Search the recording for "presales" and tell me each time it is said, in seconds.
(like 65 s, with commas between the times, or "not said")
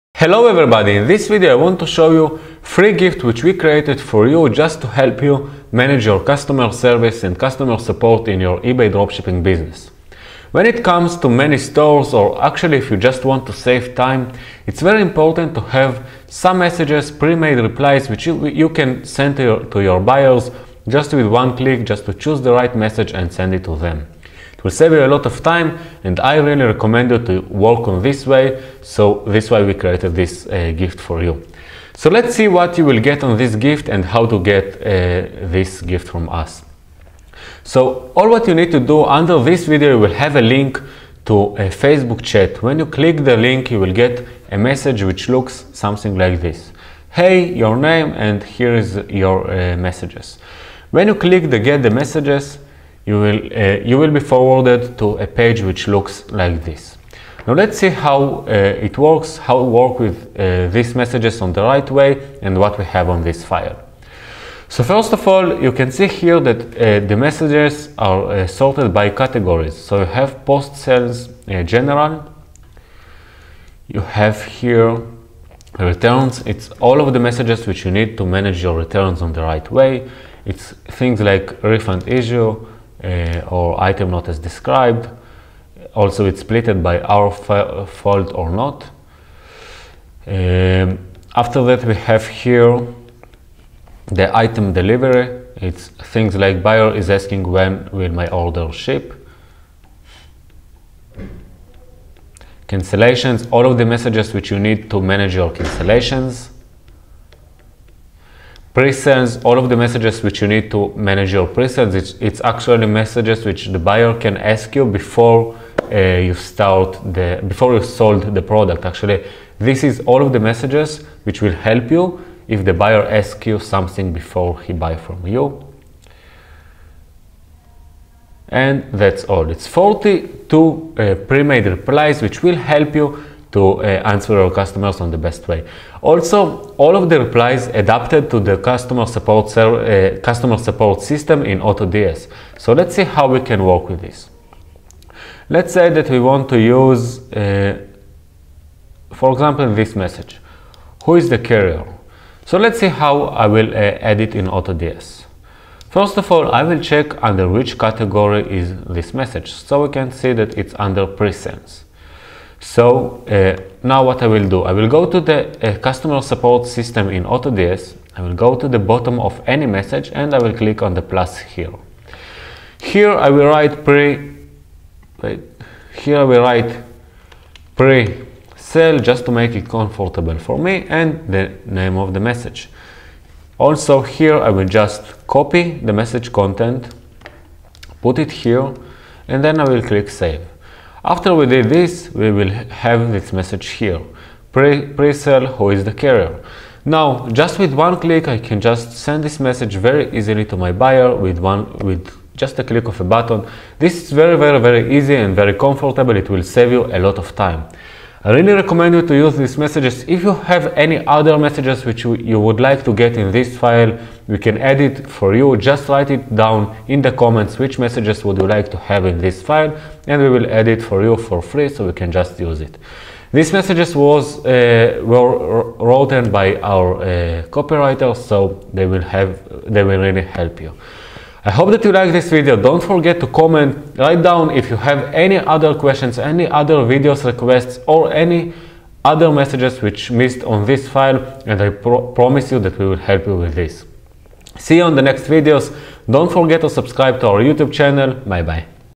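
108 s, 161 s.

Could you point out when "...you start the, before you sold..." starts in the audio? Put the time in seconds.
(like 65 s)
115 s.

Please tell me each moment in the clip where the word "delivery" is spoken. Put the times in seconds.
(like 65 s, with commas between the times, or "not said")
94 s.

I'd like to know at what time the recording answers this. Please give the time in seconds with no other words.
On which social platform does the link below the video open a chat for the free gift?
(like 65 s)
41 s.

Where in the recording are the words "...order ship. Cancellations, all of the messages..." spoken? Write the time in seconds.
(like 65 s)
98 s.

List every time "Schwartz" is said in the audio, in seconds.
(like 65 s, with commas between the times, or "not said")
not said.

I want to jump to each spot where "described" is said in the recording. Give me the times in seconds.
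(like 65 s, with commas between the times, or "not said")
84 s.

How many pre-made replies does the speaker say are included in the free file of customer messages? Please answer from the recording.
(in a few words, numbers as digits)
42.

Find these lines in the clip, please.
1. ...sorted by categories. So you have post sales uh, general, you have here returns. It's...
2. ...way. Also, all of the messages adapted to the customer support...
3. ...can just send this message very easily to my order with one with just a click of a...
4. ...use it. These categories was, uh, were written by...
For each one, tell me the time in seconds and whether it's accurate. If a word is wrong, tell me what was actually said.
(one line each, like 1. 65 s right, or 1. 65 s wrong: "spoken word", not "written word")
1. 68 s right
2. 135 s wrong: "replies", not "messages"
3. 198 s wrong: "buyer", not "order"
4. 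222 s wrong: "messages", not "categories".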